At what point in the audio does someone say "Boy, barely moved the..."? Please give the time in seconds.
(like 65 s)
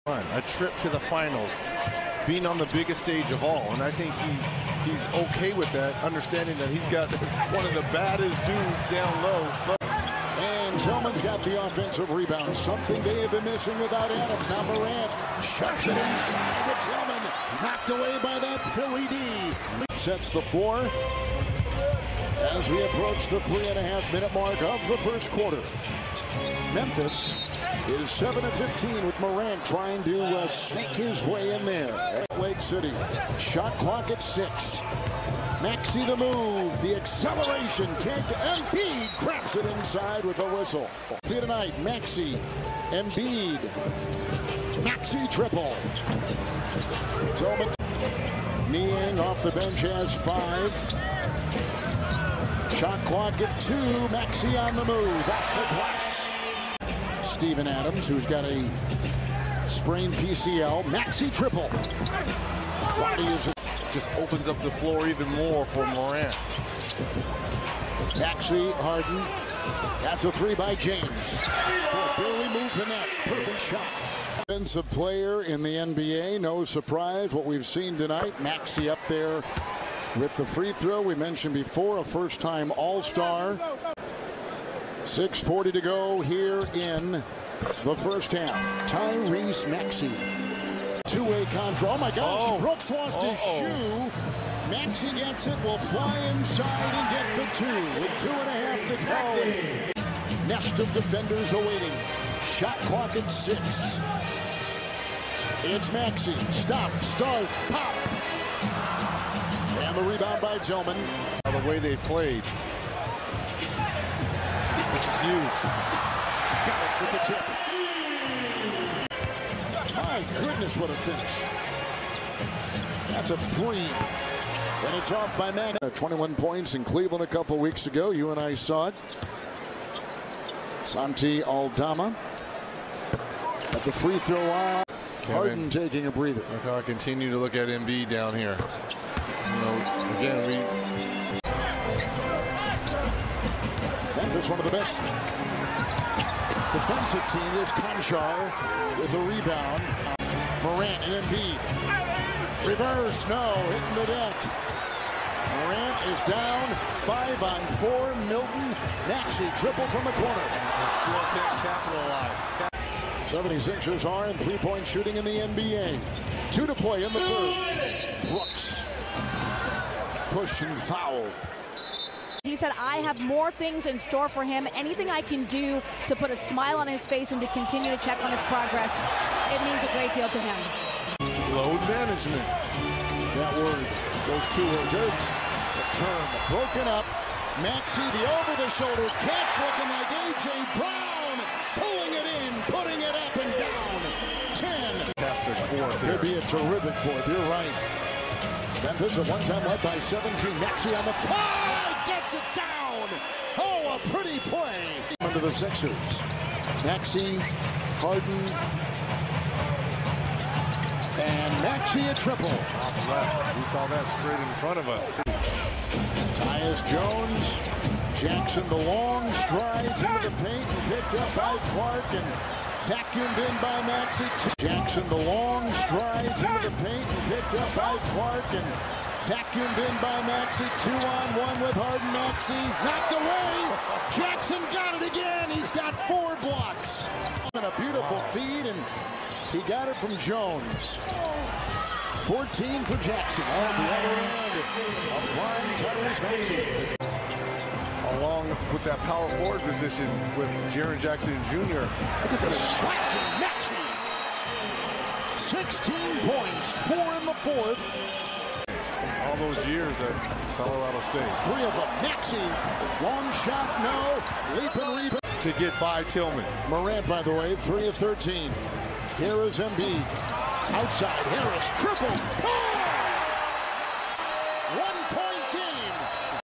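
71 s.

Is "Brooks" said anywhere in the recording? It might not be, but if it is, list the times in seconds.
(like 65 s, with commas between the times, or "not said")
92 s, 168 s.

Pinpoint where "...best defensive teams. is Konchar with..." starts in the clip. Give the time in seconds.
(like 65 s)
144 s.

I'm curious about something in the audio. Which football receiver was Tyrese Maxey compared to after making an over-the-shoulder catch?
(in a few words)
A.J. Brown.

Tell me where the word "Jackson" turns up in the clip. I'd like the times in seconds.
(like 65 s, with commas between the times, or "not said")
218 s, 224 s, 234 s, 243 s, 250 s.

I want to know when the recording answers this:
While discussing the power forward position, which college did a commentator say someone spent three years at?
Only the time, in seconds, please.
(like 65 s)
260 s.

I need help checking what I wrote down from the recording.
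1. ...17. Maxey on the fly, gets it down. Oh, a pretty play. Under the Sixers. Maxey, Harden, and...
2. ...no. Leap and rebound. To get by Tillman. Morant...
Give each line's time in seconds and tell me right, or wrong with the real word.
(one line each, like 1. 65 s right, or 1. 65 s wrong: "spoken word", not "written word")
1. 199 s right
2. 263 s right.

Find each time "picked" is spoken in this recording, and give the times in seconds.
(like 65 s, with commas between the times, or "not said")
220 s, 227 s.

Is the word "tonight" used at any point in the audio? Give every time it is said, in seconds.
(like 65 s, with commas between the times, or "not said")
41 s, 77 s.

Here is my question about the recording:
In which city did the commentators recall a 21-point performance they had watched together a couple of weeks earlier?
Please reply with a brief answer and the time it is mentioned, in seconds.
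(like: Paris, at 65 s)
Cleveland, at 126 s.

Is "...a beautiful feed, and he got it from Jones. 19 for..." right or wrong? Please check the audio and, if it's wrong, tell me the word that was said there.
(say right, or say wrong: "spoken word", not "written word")
wrong: "14", not "19".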